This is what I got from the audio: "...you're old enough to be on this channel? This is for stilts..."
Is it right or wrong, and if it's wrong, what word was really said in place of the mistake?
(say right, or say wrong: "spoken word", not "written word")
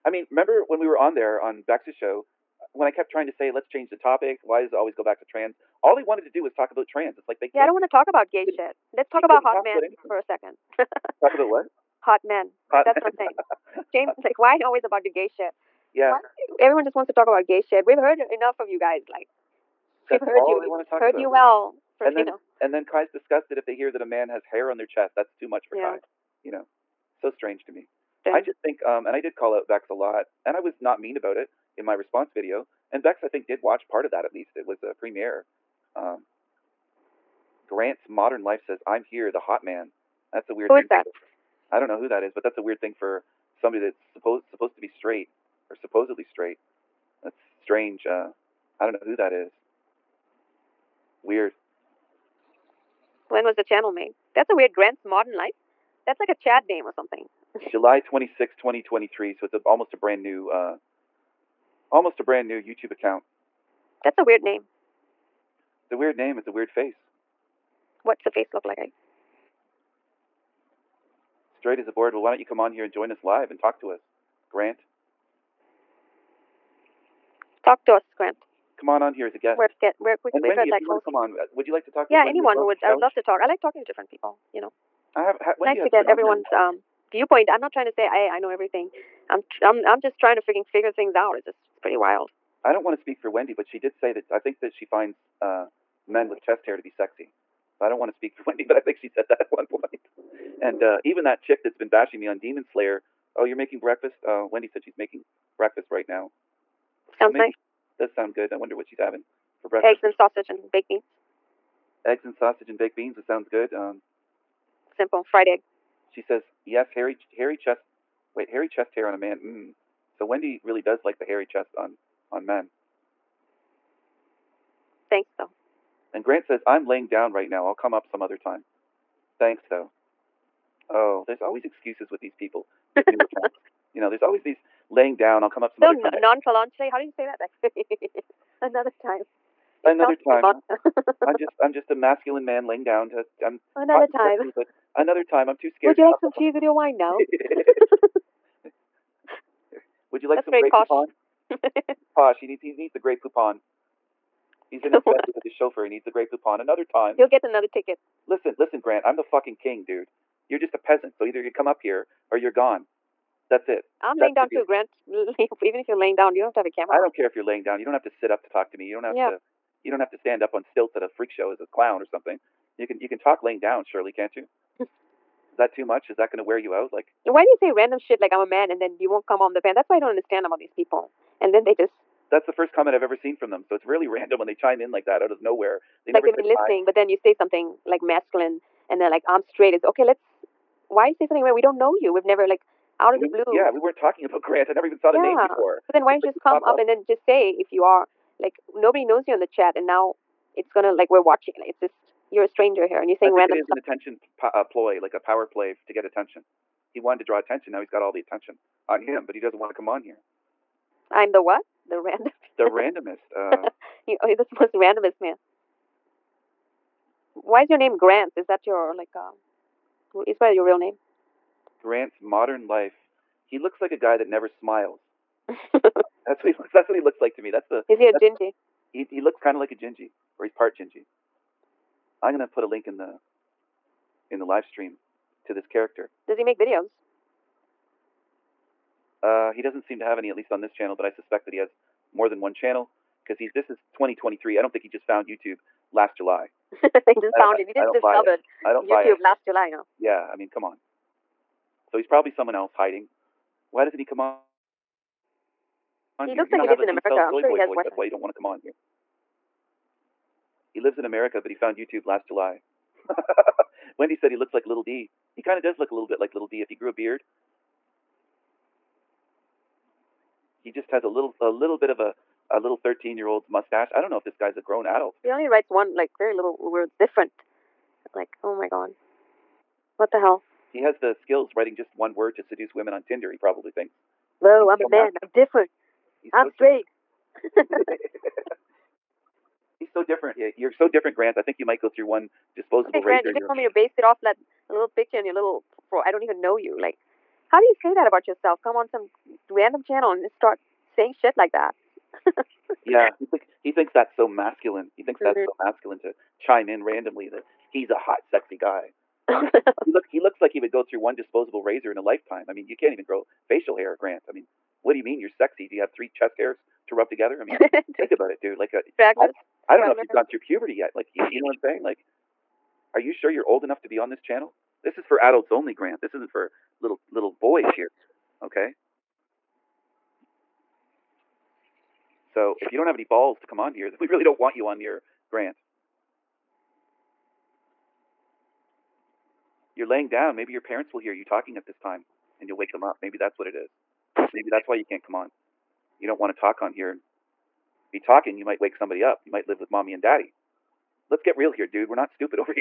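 wrong: "adults", not "stilts".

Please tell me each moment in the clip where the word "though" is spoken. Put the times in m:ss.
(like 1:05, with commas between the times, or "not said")
2:05, 2:09.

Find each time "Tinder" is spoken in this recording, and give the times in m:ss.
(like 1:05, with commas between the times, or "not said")
4:43.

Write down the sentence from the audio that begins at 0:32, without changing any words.
And Bex, I think, did watch part of that at least.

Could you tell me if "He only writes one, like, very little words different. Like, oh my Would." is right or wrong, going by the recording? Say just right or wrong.
wrong.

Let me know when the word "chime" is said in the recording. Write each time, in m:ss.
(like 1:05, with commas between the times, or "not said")
3:04, 5:06.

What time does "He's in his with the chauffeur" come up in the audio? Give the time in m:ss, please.
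2:34.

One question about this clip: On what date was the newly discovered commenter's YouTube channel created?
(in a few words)
July 26, 2023.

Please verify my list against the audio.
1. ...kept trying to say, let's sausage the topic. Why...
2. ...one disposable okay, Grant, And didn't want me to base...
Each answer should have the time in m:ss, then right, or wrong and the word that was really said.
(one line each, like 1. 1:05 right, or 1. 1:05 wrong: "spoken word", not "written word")
1. 0:02 wrong: "change", not "sausage"
2. 4:52 wrong: "You", not "And".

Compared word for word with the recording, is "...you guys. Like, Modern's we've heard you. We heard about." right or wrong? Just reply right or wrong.
wrong.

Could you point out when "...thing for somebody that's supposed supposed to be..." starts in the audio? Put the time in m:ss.
0:42.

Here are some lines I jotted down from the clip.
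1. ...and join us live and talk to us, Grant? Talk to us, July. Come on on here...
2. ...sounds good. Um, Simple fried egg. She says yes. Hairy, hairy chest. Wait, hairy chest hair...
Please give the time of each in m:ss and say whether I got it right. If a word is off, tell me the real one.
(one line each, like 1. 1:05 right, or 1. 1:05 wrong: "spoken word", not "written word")
1. 1:12 wrong: "Grant", not "July"
2. 1:53 right.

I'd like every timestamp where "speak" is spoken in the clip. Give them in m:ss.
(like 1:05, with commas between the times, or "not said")
1:32, 1:38.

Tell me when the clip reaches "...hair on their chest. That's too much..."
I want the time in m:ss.
0:24.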